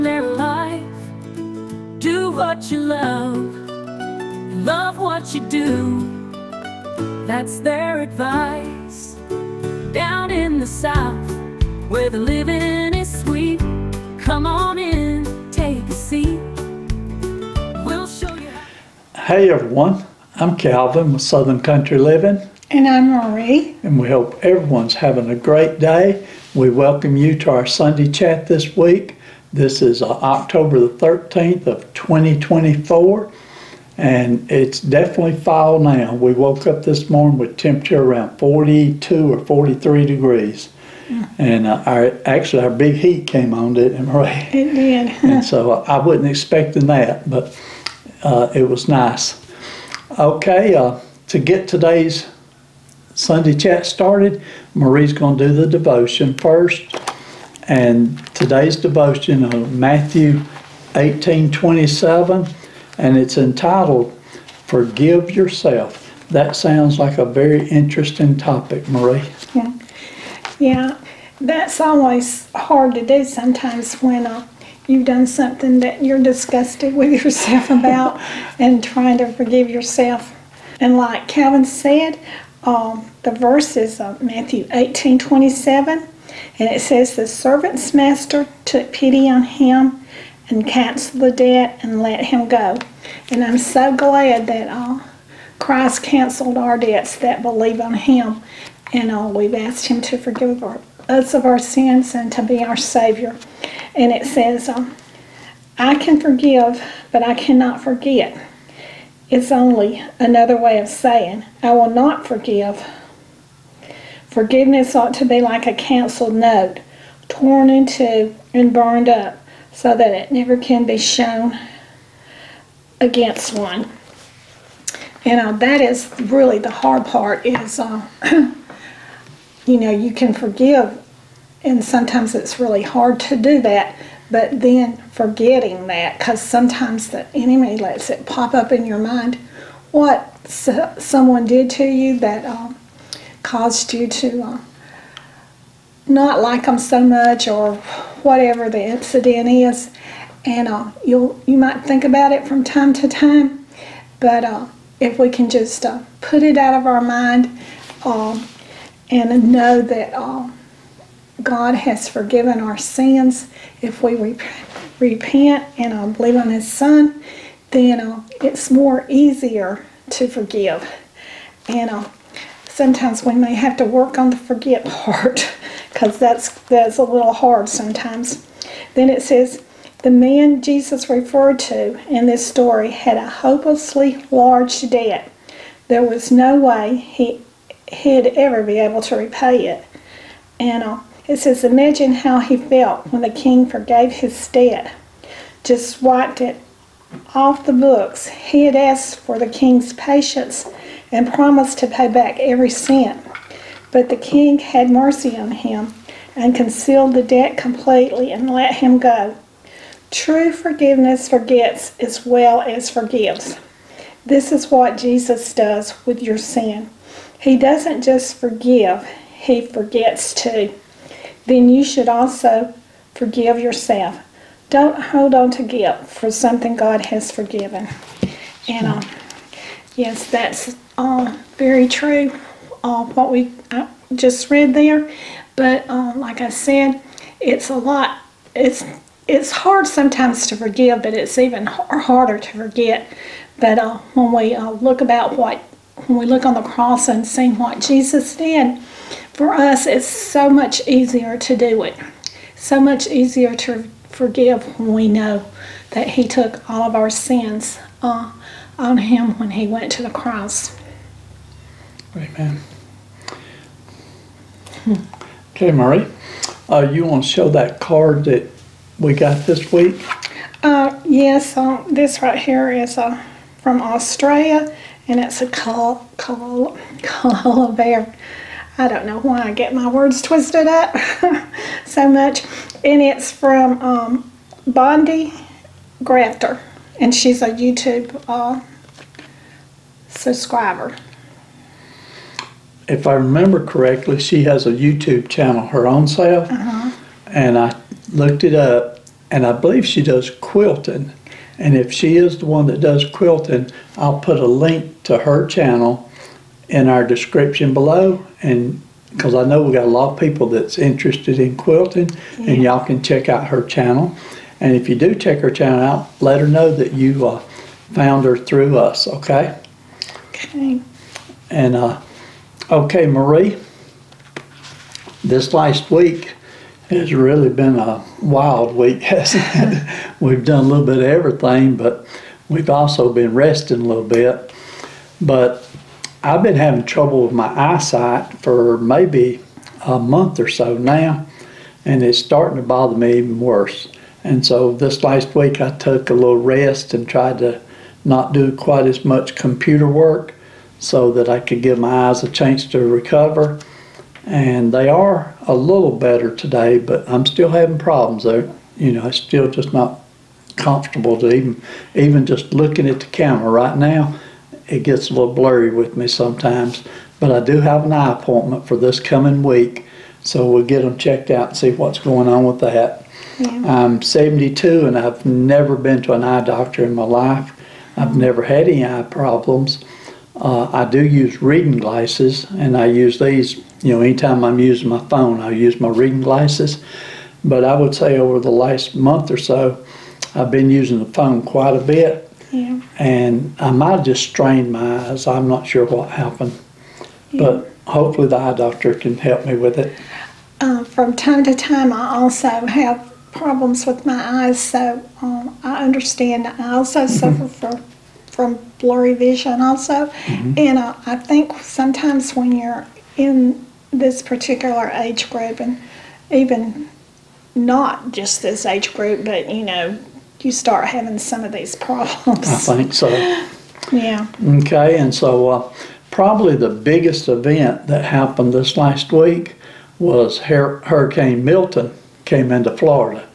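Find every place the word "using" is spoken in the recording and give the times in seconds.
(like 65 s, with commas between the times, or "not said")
384 s, 390 s.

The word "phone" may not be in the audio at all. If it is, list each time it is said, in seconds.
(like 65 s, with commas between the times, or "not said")
385 s, 391 s.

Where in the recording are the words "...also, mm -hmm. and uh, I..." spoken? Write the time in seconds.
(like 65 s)
409 s.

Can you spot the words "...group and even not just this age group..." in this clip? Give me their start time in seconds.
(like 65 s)
415 s.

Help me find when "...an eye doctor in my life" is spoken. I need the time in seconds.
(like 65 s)
376 s.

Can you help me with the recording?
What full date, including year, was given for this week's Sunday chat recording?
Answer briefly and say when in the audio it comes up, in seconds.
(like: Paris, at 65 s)
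October 13, 2024, at 30 s.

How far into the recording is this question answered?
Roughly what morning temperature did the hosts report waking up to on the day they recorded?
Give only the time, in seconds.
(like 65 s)
38 s.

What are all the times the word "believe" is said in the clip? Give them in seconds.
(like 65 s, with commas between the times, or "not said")
97 s, 166 s, 299 s.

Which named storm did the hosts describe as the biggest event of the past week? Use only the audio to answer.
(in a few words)
Hurricane Milton.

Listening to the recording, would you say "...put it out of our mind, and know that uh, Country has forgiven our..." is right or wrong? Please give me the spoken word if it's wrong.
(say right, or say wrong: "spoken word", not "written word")
wrong: "God", not "Country".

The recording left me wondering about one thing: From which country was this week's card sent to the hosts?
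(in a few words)
Australia.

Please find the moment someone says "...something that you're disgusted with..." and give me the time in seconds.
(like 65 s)
75 s.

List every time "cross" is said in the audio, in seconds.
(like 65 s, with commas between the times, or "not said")
246 s, 260 s.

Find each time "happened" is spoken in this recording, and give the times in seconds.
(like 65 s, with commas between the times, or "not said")
396 s, 428 s.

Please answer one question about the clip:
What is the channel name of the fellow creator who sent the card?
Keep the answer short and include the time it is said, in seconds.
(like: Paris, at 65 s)
Bondi Crafter, at 284 s.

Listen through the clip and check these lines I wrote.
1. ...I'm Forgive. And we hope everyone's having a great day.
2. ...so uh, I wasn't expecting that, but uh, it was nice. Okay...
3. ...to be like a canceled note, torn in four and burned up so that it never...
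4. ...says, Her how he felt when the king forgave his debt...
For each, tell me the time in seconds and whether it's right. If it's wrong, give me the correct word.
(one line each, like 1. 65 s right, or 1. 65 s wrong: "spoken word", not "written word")
1. 22 s wrong: "Marie", not "Forgive"
2. 45 s right
3. 115 s wrong: "two", not "four"
4. 191 s wrong: "Imagine", not "Her".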